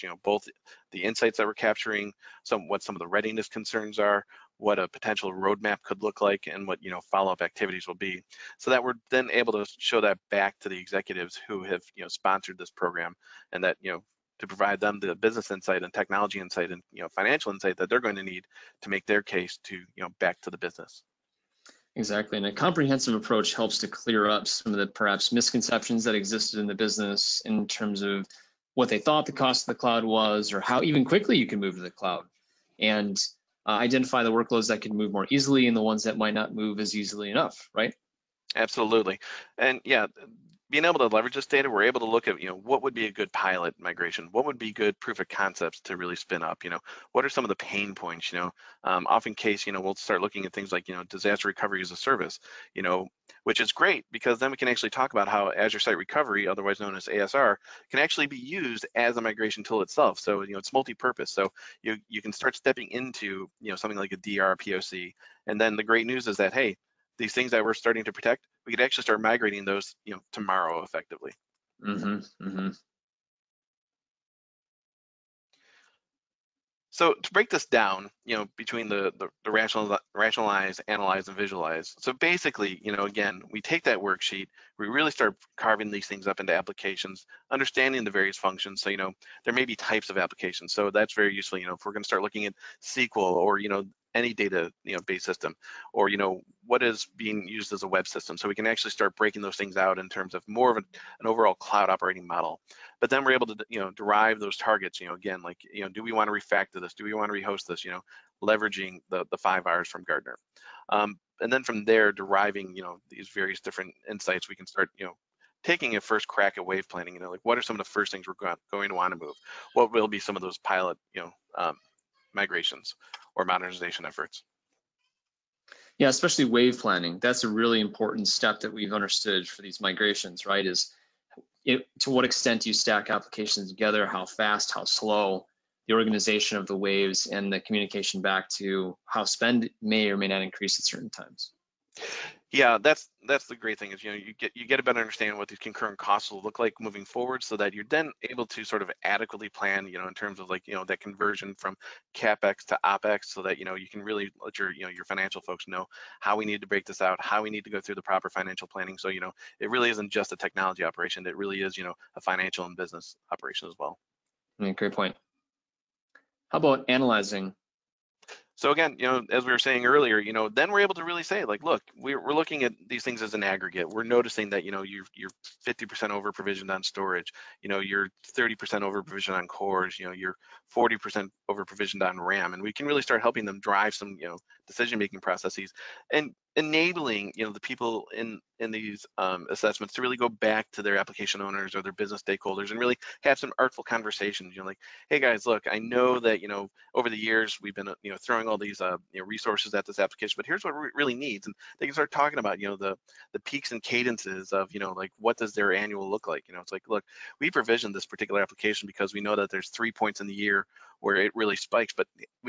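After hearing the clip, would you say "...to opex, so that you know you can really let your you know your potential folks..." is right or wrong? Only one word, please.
wrong.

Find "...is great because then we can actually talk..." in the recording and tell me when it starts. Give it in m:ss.
0:53.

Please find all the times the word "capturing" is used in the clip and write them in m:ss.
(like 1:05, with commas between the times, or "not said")
0:01.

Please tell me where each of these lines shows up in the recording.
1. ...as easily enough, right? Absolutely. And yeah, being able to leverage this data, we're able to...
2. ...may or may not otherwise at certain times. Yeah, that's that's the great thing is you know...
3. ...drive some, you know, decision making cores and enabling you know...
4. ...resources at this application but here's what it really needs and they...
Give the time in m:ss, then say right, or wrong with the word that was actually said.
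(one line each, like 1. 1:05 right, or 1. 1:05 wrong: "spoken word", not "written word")
1. 0:36 right
2. 2:19 wrong: "increase", not "otherwise"
3. 3:03 wrong: "processes", not "cores"
4. 3:19 right.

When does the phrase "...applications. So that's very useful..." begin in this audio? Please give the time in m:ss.
1:30.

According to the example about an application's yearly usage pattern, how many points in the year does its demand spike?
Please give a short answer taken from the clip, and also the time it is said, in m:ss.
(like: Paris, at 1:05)
3, at 3:29.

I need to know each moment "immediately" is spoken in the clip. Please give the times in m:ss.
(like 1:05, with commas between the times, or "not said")
not said.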